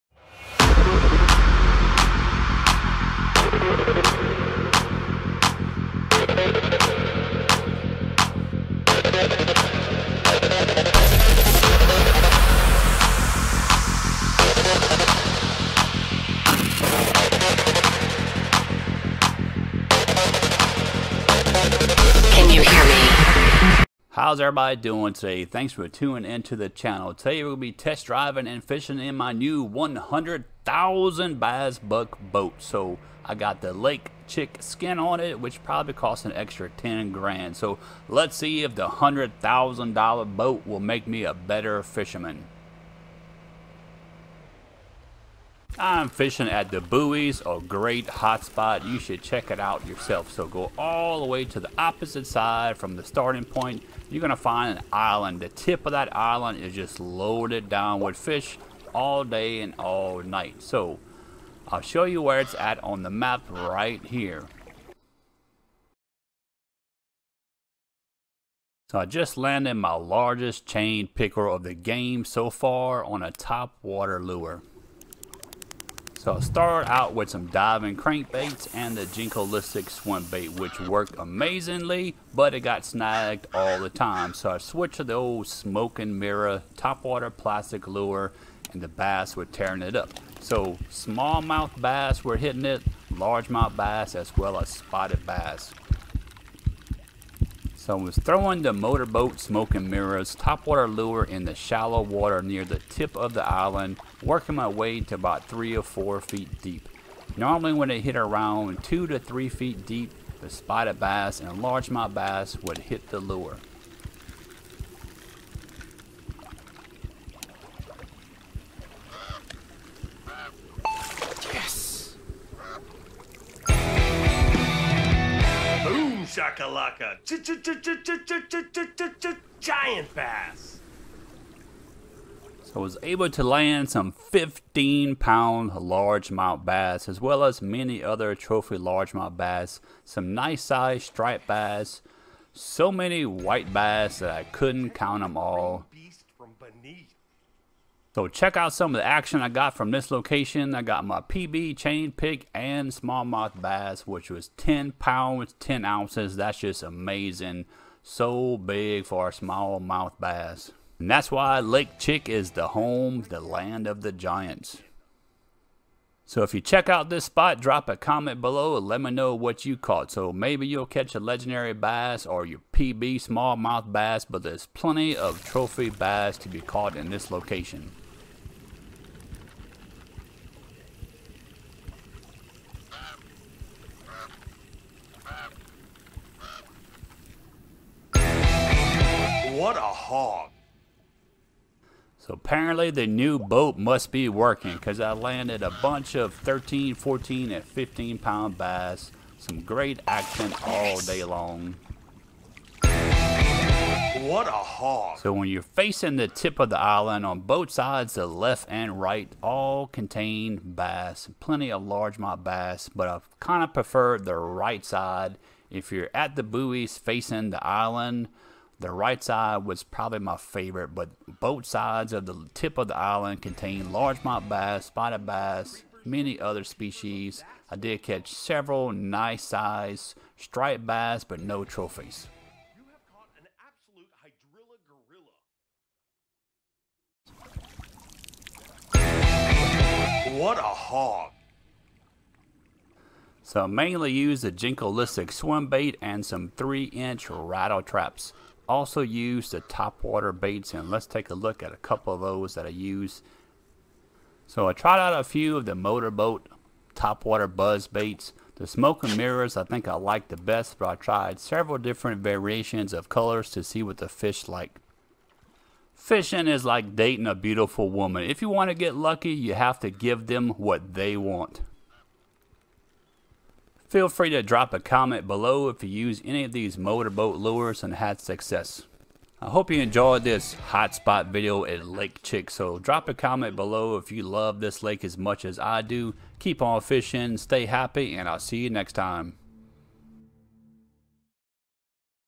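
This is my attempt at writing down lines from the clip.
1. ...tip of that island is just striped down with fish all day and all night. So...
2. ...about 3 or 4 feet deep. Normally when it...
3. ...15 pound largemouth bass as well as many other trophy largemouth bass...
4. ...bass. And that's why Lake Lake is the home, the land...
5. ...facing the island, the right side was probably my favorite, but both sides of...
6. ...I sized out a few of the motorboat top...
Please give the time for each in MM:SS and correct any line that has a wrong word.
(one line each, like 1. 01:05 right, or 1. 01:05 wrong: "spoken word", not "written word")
1. 00:55 wrong: "loaded", not "striped"
2. 01:45 right
3. 02:14 right
4. 02:40 wrong: "Chick", not "Lake"
5. 03:36 right
6. 04:14 wrong: "tried", not "sized".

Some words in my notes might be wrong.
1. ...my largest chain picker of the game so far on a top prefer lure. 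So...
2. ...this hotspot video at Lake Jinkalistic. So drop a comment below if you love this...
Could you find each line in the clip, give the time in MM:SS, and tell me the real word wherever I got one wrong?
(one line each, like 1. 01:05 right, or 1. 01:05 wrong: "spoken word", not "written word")
1. 01:09 wrong: "water", not "prefer"
2. 04:40 wrong: "Chick", not "Jinkalistic".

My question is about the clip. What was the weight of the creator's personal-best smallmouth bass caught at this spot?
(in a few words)
10 pounds, 10 ounces.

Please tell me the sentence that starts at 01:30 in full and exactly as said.
So smallmouth bass were hitting it, largemouth bass as well as spotted bass.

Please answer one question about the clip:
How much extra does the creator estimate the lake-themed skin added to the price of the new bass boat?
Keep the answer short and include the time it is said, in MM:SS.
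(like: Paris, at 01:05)
10 grand, at 00:36.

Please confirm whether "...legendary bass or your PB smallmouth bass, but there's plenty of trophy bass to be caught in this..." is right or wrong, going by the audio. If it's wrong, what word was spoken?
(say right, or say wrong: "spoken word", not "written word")
right.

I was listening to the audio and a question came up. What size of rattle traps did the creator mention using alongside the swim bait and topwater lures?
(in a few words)
3 inch.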